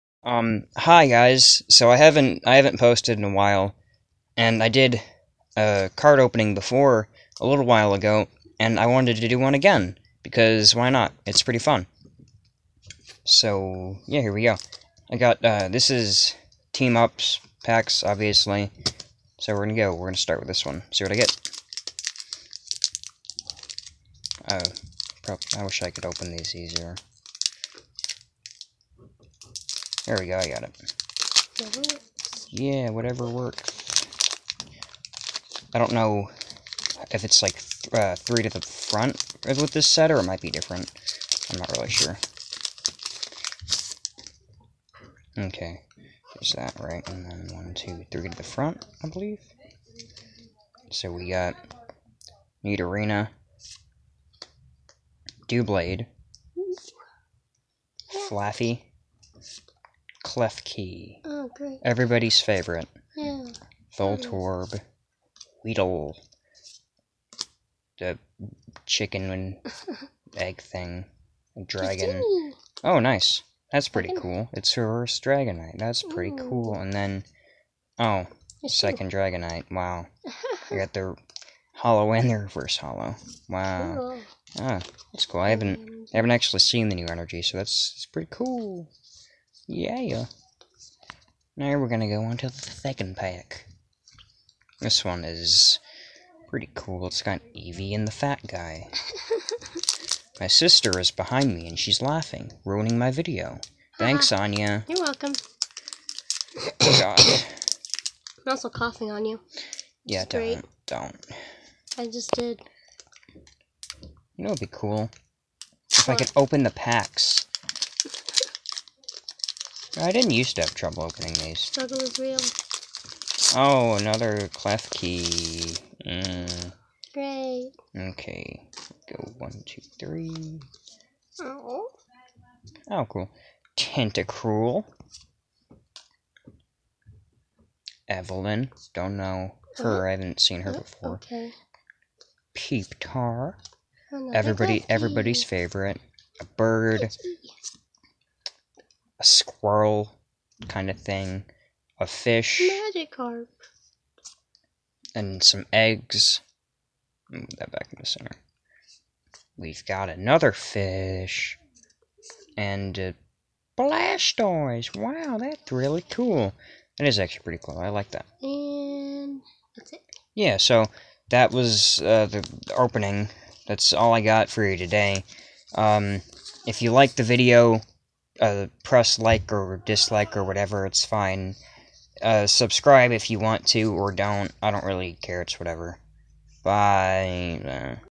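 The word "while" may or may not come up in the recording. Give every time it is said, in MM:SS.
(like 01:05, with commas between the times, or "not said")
00:03, 00:07.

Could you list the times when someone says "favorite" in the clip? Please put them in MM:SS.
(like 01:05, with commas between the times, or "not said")
01:02, 02:25.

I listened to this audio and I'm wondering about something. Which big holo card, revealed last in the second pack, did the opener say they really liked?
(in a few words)
Blastoise.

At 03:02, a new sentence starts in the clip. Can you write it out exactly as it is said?
Uh, subscribe if you want to or don't.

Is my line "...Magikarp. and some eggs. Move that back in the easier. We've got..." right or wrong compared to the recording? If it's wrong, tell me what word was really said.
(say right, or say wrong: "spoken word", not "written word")
wrong: "center", not "easier".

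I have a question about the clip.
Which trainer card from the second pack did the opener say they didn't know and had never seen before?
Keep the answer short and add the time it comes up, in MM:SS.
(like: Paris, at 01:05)
Evelyn, at 02:18.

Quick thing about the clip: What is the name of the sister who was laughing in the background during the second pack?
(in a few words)
Anya.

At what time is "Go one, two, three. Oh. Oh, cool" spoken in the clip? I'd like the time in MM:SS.
02:09.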